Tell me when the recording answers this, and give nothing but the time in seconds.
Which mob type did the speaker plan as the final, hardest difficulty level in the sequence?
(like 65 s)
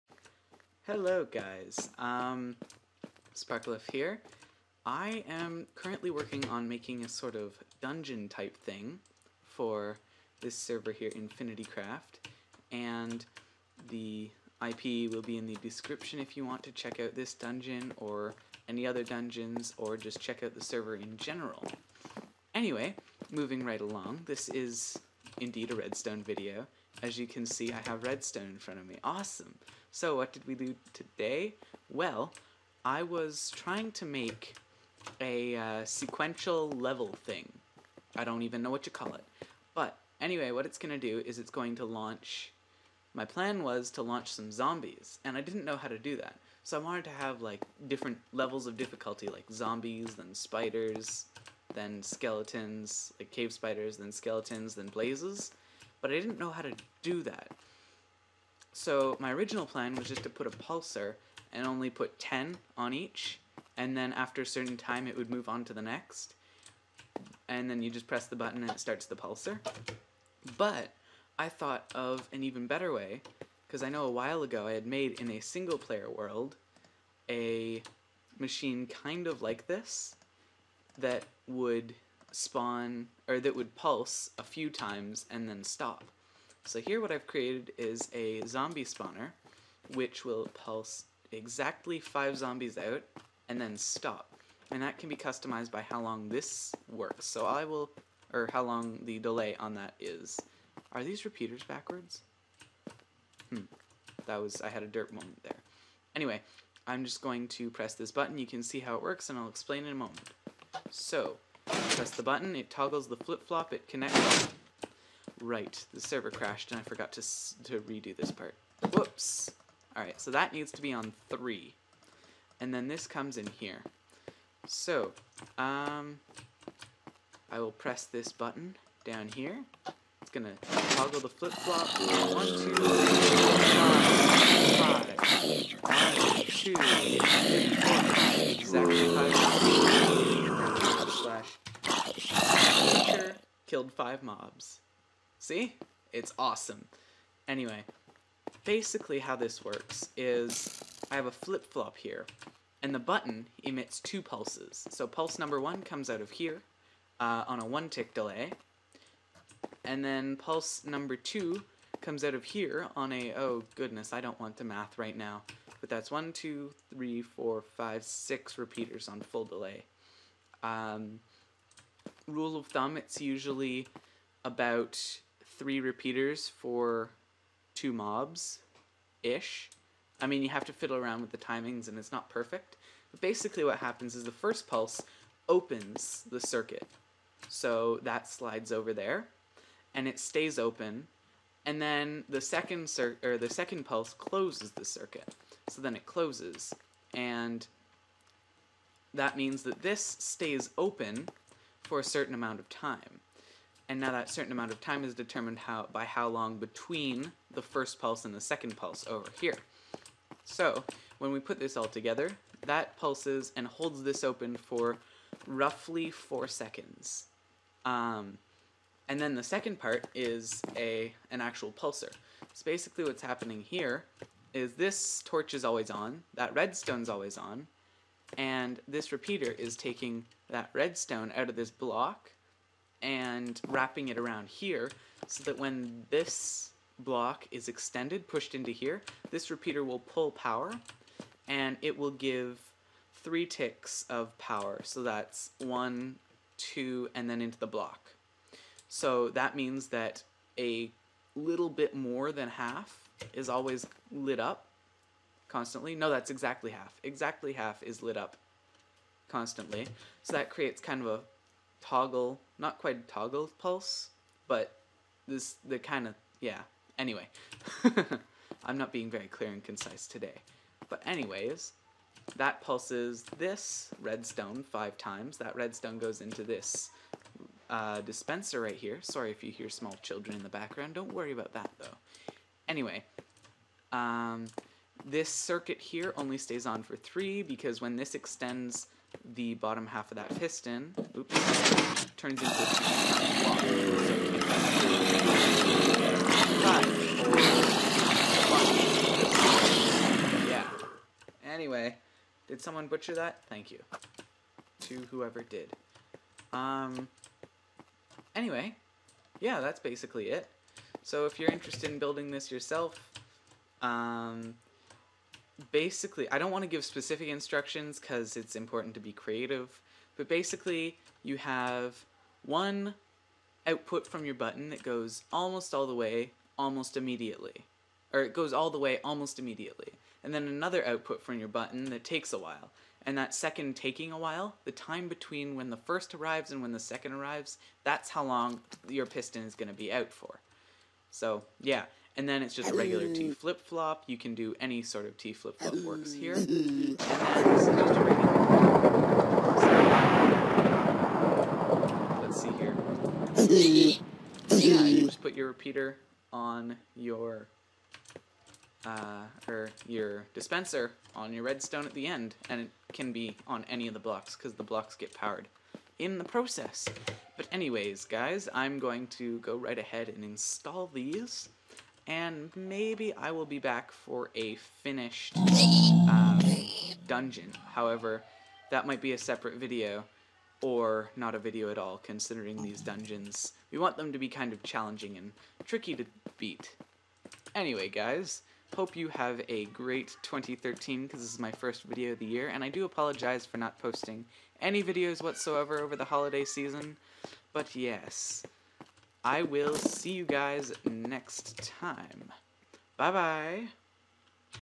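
54 s.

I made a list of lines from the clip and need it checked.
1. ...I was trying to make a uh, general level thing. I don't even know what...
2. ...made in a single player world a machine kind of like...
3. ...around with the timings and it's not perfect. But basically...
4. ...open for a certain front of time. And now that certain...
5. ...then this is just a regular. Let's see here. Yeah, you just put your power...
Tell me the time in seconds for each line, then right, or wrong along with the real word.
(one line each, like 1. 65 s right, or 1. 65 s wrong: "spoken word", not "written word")
1. 32 s wrong: "sequential", not "general"
2. 74 s right
3. 180 s right
4. 200 s wrong: "amount", not "front"
5. 346 s wrong: "repeater", not "power".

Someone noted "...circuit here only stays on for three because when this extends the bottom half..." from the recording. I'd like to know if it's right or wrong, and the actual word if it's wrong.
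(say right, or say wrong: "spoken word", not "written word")
right.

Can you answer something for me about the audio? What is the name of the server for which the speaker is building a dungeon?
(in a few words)
Infinity Craft.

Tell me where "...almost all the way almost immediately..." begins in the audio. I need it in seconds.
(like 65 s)
325 s.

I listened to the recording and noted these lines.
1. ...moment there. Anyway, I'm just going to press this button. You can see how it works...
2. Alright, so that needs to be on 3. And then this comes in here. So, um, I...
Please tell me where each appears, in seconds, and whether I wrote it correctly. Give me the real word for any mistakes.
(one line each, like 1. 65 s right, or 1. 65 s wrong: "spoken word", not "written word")
1. 105 s right
2. 119 s right.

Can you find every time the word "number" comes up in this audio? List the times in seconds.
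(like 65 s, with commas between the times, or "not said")
155 s, 160 s.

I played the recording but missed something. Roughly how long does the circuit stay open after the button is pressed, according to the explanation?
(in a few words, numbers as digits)
4 seconds.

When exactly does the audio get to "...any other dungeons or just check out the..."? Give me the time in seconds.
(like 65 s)
18 s.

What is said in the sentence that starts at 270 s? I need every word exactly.
But anyways, that pulses this redstone five times.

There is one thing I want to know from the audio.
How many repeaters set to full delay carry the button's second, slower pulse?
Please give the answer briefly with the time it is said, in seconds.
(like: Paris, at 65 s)
6, at 168 s.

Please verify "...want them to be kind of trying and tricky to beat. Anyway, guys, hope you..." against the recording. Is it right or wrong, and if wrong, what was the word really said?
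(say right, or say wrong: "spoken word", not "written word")
wrong: "challenging", not "trying".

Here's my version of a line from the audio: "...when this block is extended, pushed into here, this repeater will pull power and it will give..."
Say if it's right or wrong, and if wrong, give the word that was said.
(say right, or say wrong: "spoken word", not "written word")
right.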